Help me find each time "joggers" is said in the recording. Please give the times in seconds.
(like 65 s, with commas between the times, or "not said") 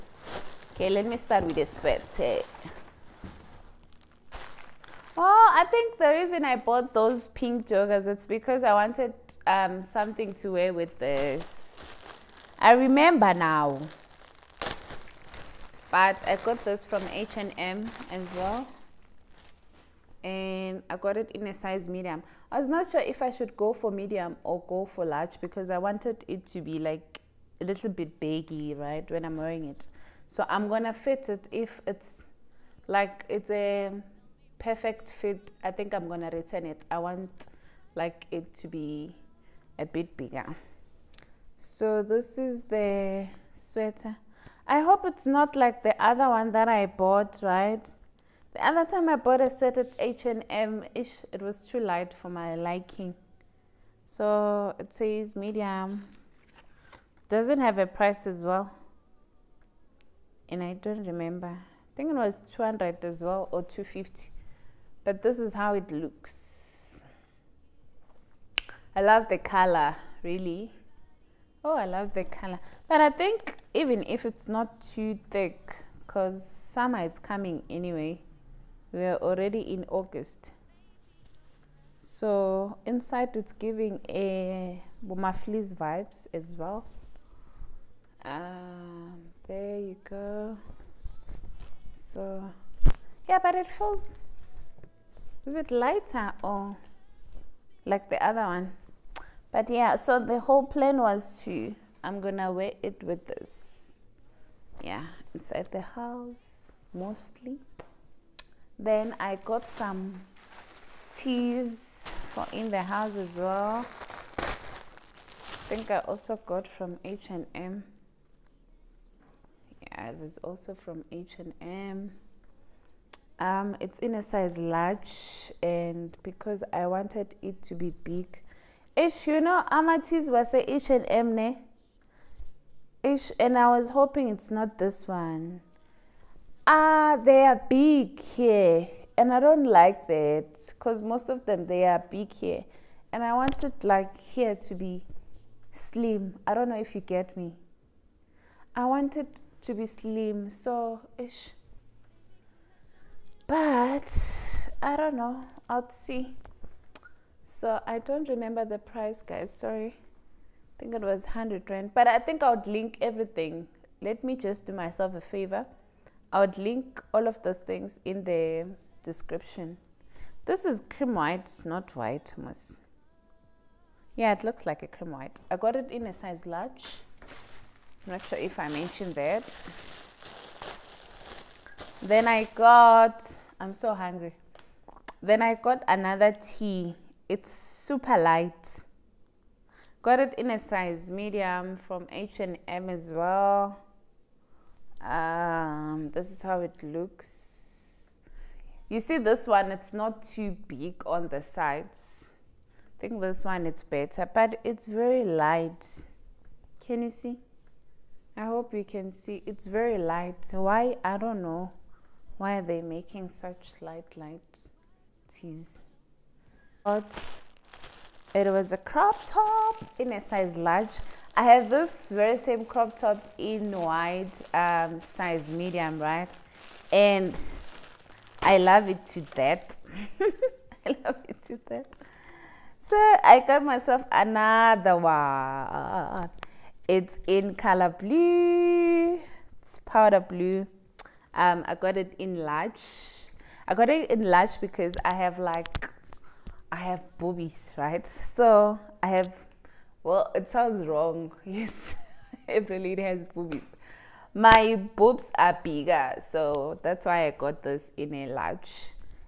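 7 s.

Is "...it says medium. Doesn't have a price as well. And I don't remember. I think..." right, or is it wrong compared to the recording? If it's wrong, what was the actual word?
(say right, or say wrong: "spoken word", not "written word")
right.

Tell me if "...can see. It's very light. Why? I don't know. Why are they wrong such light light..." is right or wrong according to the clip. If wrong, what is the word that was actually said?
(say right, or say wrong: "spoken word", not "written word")
wrong: "making", not "wrong".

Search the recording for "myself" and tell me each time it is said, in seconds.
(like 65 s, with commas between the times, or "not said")
164 s, 233 s.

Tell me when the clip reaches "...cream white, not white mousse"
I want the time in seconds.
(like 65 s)
170 s.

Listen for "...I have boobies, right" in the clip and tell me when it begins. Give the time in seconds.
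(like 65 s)
246 s.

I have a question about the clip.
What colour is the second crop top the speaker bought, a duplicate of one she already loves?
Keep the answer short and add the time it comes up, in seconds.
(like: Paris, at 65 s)
Powder blue, at 239 s.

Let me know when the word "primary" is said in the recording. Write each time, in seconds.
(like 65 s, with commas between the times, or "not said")
not said.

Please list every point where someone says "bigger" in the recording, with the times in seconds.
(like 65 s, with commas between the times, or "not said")
40 s, 255 s.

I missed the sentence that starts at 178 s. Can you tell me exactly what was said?
I'm not sure if I mentioned that.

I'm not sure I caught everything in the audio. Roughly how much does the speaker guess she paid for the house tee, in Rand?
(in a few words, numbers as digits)
100 Rand.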